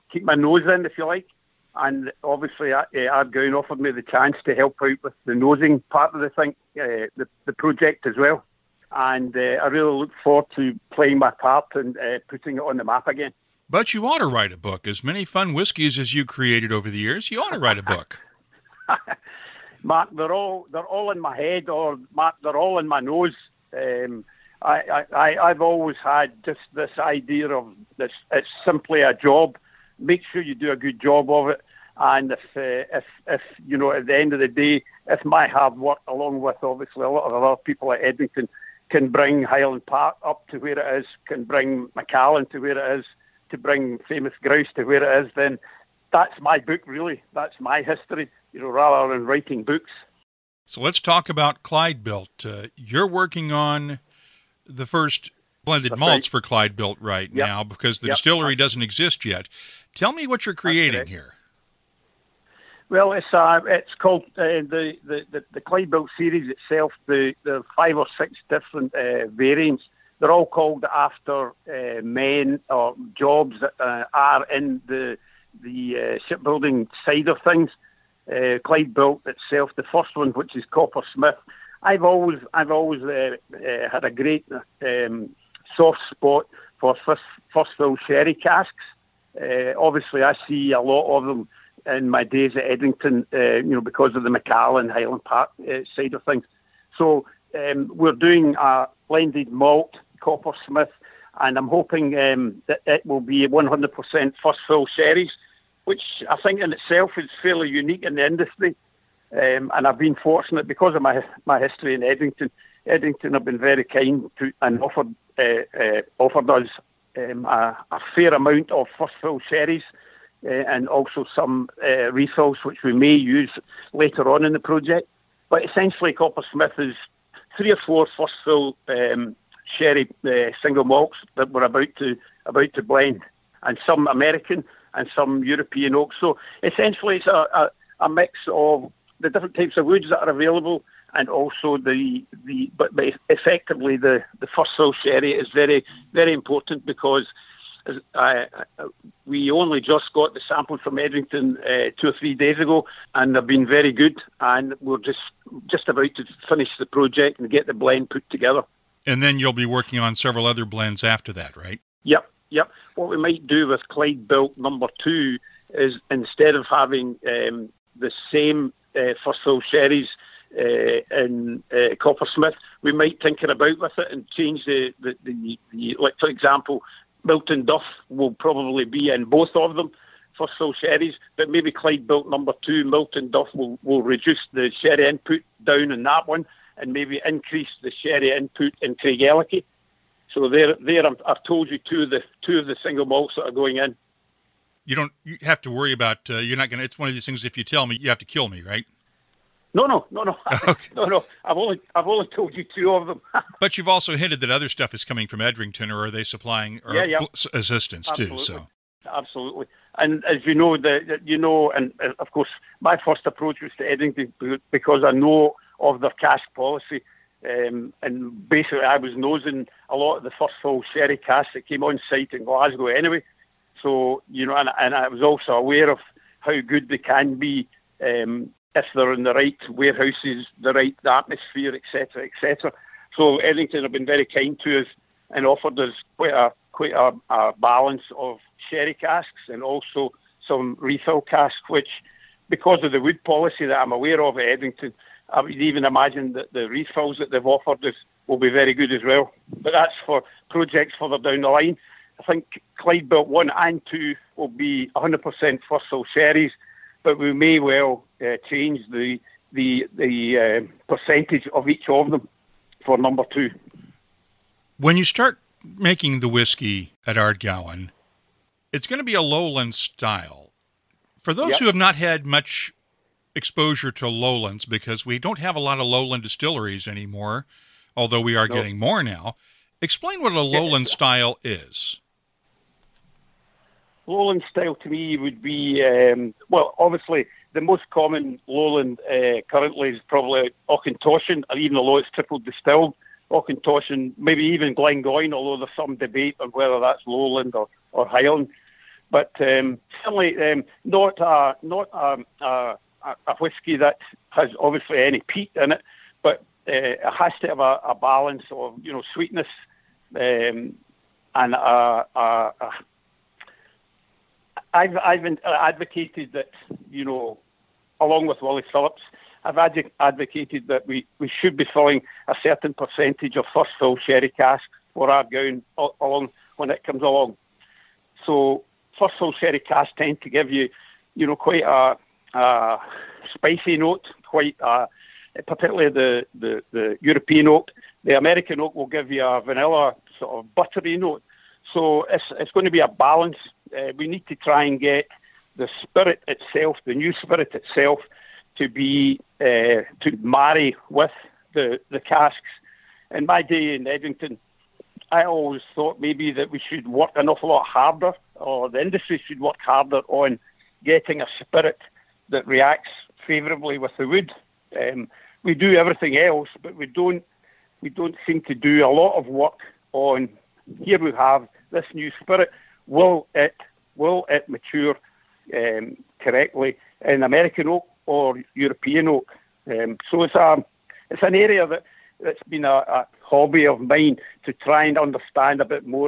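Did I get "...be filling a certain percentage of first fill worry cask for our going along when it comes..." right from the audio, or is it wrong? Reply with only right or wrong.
wrong.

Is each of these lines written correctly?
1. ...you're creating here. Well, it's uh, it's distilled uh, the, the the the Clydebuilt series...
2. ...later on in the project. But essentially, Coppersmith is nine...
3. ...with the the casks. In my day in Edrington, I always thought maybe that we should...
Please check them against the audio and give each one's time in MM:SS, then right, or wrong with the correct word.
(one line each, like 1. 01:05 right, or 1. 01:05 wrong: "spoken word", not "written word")
1. 01:00 wrong: "called", not "distilled"
2. 02:03 wrong: "three", not "nine"
3. 05:50 right.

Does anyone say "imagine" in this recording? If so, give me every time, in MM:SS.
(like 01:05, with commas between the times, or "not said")
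04:05.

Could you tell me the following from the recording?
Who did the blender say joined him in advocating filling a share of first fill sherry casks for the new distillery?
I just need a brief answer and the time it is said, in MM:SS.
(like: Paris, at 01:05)
Willie Phillips, at 05:18.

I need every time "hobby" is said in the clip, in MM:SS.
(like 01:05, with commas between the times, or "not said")
06:23.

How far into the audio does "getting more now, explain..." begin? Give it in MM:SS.
04:38.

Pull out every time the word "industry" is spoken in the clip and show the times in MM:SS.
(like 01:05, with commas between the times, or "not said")
01:48, 05:58.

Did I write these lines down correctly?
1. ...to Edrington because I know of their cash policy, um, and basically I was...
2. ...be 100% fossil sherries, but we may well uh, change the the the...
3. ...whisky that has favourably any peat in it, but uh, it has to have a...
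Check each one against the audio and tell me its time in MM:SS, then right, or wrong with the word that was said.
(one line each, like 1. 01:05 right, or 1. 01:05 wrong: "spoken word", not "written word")
1. 03:33 right
2. 04:14 right
3. 05:03 wrong: "obviously", not "favourably".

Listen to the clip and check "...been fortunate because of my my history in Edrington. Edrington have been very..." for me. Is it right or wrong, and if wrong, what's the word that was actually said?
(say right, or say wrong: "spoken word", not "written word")
right.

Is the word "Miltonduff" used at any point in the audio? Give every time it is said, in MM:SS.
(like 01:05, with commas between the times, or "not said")
02:57, 03:02.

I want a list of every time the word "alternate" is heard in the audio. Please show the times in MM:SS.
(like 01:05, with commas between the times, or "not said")
not said.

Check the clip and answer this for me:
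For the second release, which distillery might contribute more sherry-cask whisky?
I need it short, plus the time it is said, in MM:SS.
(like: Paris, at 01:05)
Craigellachie, at 03:08.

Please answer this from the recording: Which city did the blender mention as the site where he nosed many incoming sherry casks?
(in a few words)
Glasgow.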